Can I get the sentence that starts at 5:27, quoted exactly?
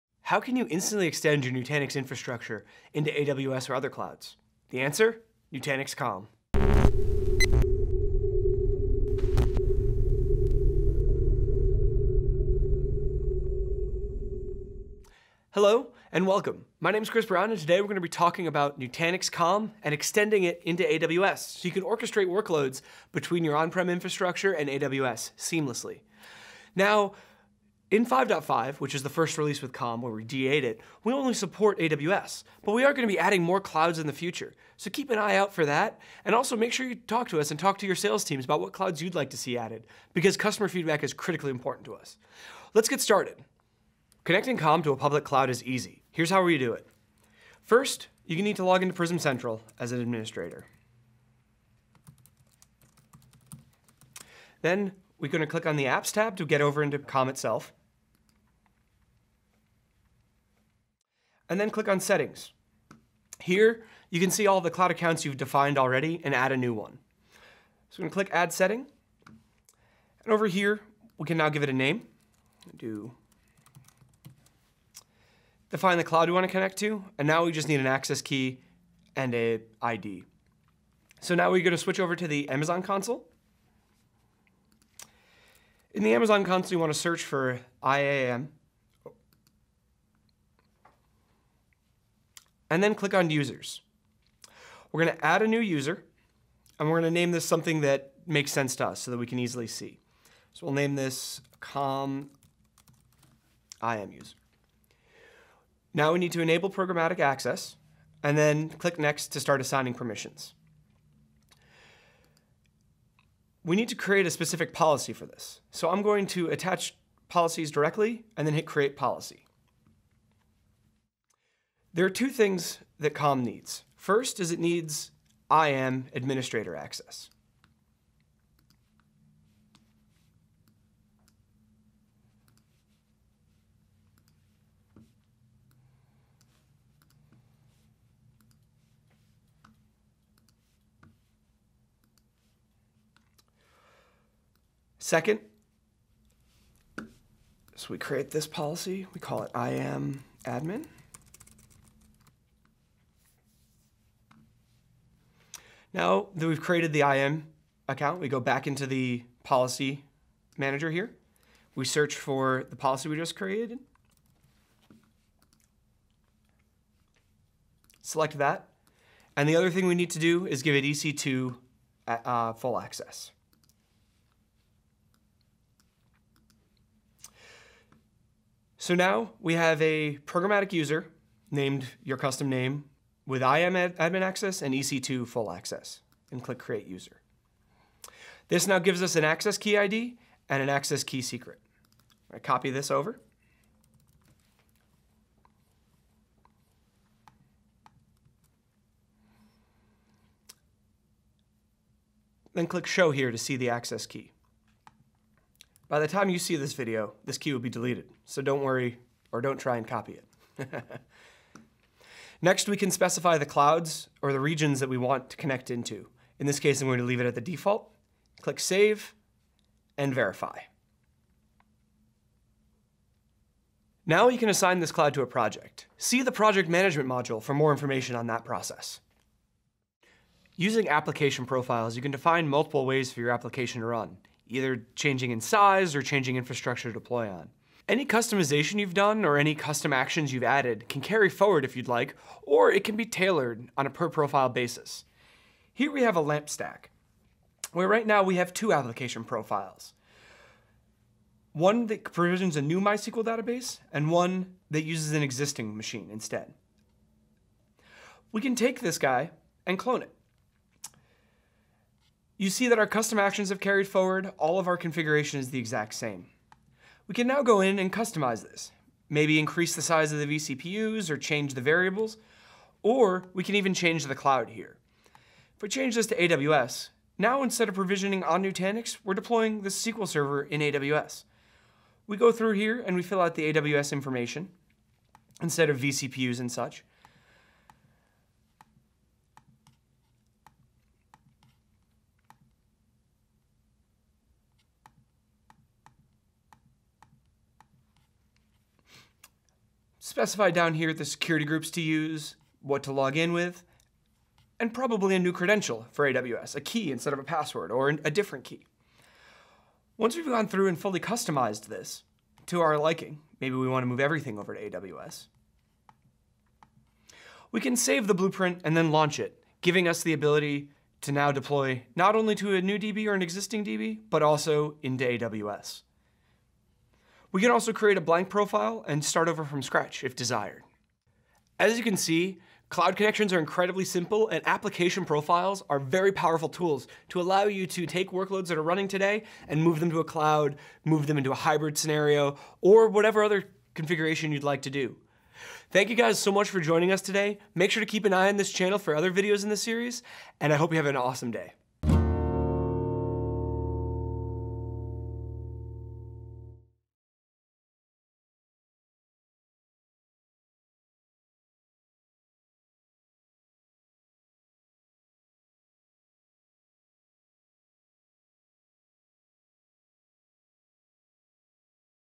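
We can also create a blank profile and start over from scratch if desired.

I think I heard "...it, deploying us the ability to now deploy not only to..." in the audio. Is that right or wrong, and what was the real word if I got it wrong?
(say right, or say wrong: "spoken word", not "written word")
wrong: "giving", not "deploying".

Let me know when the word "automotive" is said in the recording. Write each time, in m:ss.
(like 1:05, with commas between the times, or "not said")
not said.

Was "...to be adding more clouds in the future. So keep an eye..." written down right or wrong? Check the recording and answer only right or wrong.
right.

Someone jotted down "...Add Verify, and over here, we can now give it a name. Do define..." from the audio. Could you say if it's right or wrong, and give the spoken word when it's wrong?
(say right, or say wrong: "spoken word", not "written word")
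wrong: "Setting", not "Verify".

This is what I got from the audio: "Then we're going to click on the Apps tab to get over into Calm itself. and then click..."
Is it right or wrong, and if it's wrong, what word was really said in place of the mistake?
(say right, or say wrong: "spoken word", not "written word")
right.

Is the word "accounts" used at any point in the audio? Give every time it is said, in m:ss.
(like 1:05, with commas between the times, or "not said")
1:04, 2:37.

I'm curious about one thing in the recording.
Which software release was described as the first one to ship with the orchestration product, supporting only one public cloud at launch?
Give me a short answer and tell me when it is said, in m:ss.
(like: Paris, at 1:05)
5.5, at 0:28.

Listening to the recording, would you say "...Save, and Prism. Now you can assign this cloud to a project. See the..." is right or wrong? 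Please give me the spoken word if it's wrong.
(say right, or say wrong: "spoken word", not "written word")
wrong: "Verify", not "Prism".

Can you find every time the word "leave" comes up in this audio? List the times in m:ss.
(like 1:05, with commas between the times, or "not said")
3:37.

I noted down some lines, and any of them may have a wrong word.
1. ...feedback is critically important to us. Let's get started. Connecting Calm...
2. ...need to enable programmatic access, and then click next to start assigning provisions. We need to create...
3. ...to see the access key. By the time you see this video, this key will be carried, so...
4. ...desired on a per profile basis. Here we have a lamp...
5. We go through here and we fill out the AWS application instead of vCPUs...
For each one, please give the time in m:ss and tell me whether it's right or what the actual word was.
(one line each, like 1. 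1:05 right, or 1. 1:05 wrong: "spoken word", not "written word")
1. 0:40 right
2. 1:46 wrong: "permissions", not "provisions"
3. 3:23 wrong: "deleted", not "carried"
4. 4:03 wrong: "tailored", not "desired"
5. 4:42 wrong: "information", not "application".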